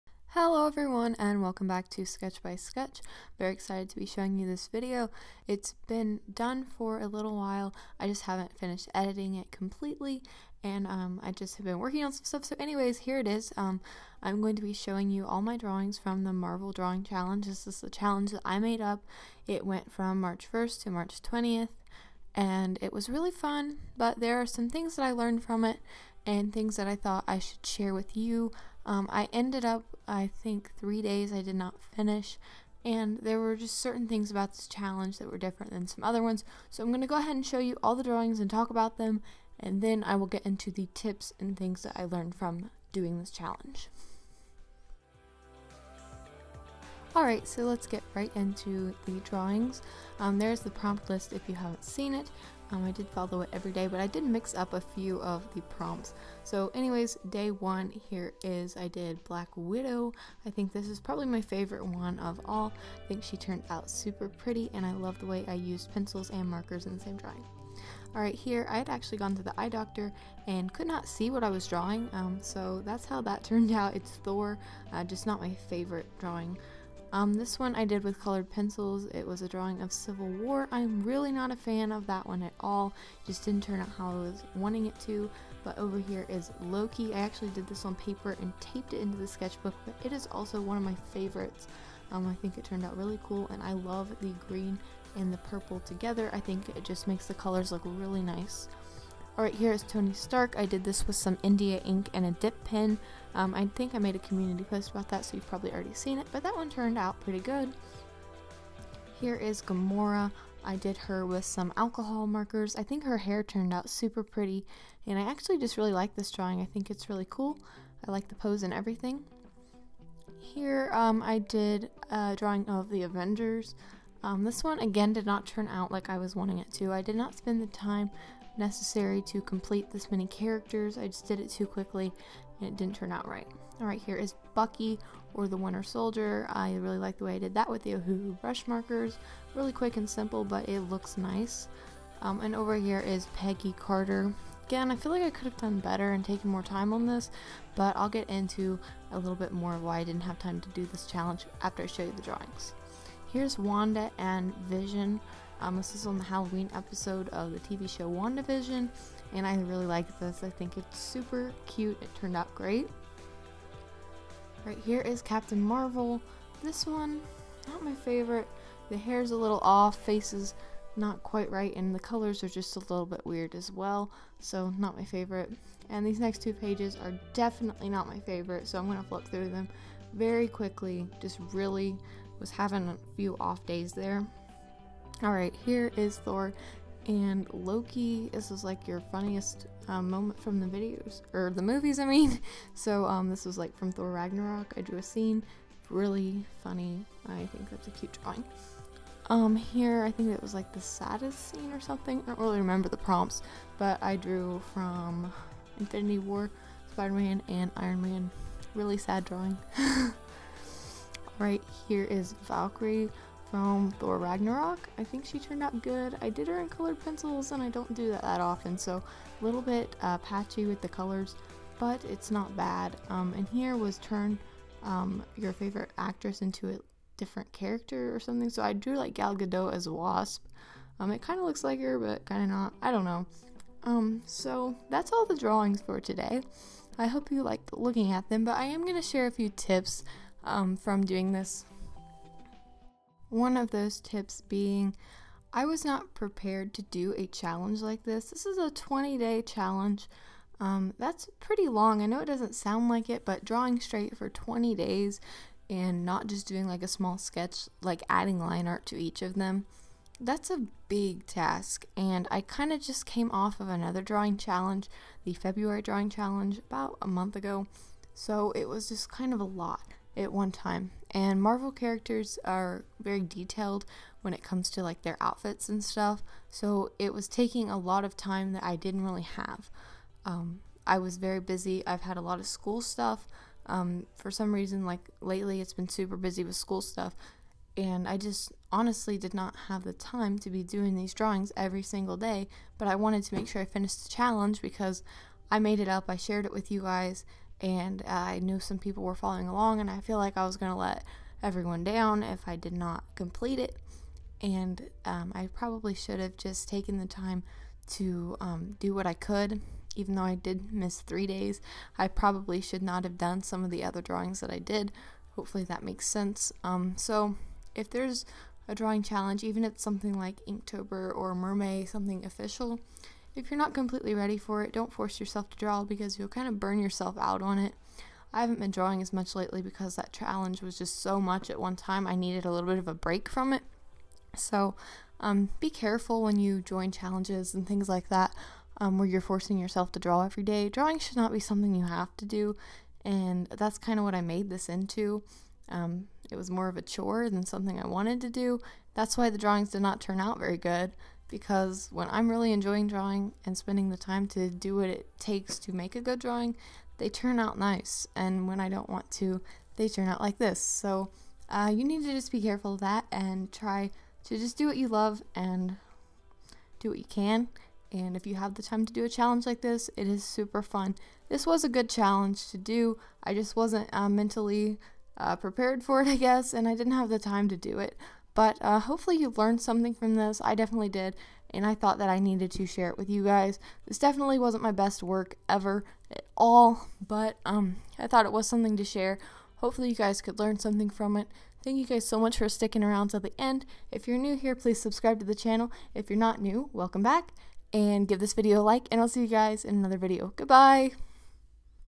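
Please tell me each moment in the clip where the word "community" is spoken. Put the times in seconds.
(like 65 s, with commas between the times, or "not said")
104 s.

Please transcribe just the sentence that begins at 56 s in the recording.
So, anyways, day one here is I did Black Widow.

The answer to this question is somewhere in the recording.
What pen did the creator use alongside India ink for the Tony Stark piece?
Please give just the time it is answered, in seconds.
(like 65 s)
102 s.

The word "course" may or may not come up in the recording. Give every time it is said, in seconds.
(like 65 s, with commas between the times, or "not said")
not said.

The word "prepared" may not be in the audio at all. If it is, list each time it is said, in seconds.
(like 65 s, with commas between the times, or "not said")
246 s, 375 s.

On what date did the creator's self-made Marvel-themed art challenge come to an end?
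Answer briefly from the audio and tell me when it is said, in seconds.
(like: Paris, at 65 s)
March 20th, at 20 s.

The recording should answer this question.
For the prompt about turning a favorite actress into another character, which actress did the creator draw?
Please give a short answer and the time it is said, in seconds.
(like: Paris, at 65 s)
Gal Gadot, at 229 s.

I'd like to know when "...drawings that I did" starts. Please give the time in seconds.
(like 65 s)
314 s.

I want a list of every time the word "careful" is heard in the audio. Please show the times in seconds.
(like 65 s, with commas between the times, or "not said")
335 s, 362 s.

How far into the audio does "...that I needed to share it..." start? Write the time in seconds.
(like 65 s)
381 s.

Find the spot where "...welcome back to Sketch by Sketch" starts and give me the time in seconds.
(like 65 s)
1 s.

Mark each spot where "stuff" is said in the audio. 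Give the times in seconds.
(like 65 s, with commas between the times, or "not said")
12 s, 275 s, 282 s, 286 s.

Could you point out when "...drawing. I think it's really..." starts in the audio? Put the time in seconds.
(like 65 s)
116 s.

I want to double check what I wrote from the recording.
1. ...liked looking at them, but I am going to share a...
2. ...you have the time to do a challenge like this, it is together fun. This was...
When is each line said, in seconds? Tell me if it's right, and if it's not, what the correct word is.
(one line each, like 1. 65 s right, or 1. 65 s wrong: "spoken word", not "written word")
1. 237 s right
2. 368 s wrong: "super", not "together".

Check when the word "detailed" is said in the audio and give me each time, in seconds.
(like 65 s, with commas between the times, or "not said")
273 s.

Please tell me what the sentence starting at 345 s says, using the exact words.
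Um, it was more of a chore than something I wanted to do.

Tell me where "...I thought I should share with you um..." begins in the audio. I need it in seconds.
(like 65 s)
26 s.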